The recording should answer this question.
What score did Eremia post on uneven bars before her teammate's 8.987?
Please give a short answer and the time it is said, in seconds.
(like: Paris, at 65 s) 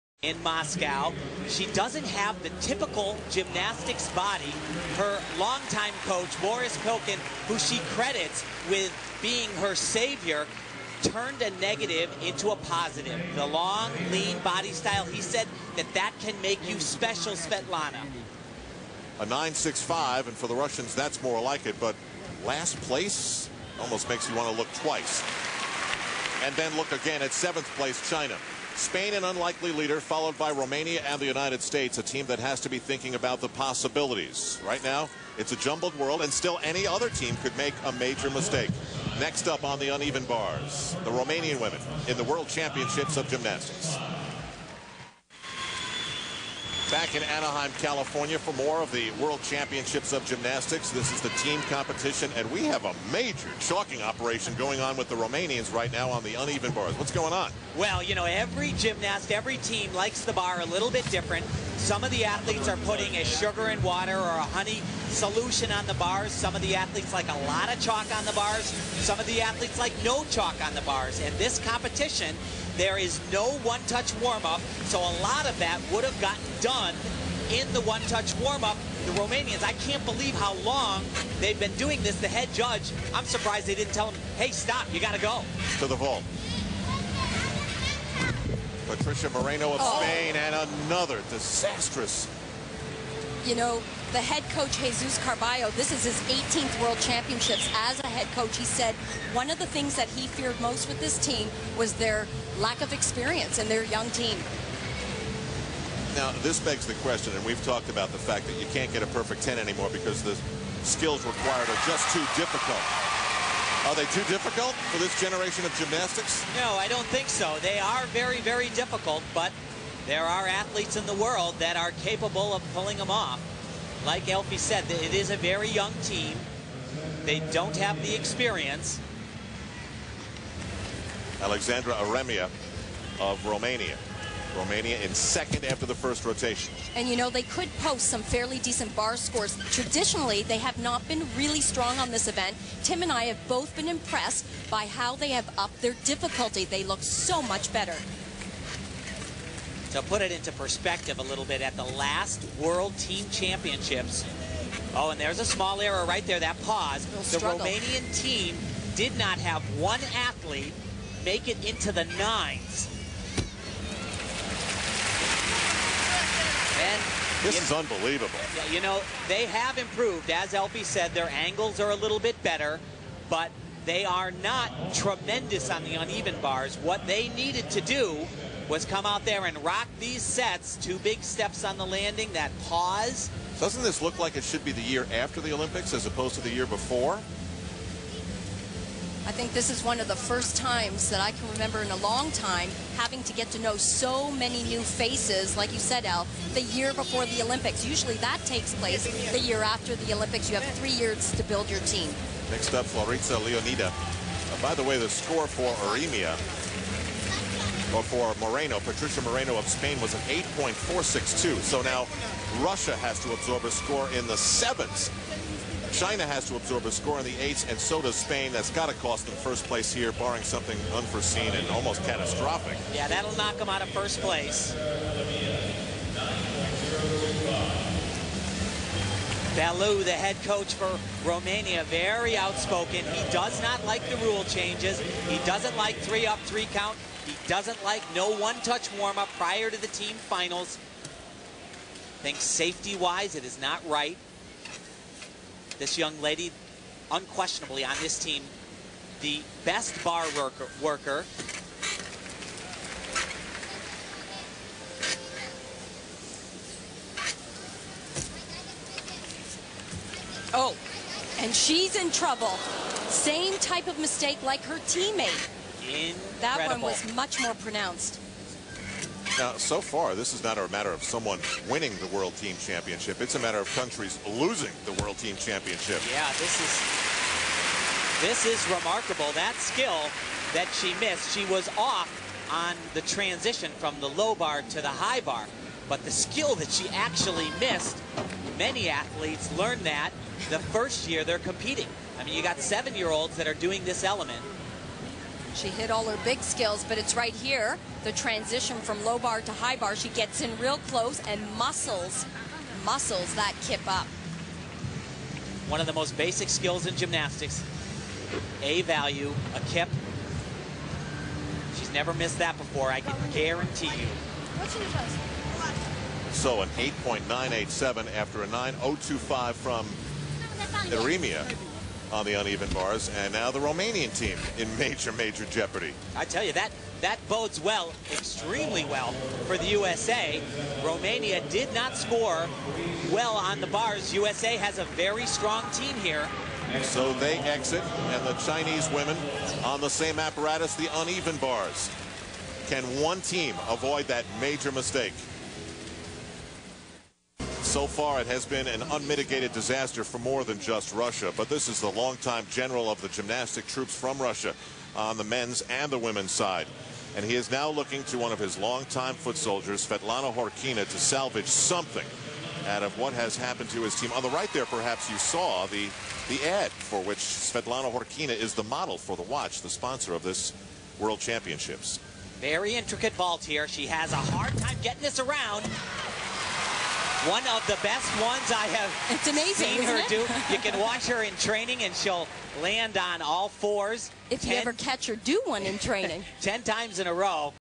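9.025, at 318 s.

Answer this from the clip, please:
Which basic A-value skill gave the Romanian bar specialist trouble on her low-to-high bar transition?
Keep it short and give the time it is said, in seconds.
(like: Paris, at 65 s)
a kip, at 309 s.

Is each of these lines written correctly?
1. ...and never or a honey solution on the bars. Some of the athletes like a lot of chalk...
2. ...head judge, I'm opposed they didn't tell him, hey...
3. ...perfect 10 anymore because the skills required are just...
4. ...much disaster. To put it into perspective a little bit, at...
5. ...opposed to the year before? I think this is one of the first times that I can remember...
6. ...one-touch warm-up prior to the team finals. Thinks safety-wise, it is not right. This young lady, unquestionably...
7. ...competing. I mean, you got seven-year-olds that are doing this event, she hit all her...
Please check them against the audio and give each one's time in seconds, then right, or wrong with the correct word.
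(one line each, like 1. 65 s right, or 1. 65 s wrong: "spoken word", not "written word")
1. 63 s wrong: "water", not "never"
2. 82 s wrong: "surprised", not "opposed"
3. 109 s right
4. 147 s wrong: "better", not "disaster"
5. 186 s right
6. 238 s right
7. 291 s wrong: "element", not "event".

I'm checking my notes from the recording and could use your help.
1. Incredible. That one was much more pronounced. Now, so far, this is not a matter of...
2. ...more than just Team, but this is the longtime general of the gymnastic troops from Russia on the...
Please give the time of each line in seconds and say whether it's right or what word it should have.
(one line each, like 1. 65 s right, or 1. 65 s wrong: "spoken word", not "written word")
1. 265 s right
2. 350 s wrong: "Russia", not "Team".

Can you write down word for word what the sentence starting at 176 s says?
What they needed to do was come out there and rock these sets.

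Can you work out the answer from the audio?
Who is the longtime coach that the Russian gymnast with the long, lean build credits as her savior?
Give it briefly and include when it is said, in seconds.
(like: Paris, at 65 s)
Boris Pilkin, at 6 s.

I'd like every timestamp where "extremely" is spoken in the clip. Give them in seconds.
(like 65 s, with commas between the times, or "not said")
328 s.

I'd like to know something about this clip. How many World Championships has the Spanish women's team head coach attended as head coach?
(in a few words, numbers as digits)
18.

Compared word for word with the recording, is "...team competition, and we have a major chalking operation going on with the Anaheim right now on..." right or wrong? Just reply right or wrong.
wrong.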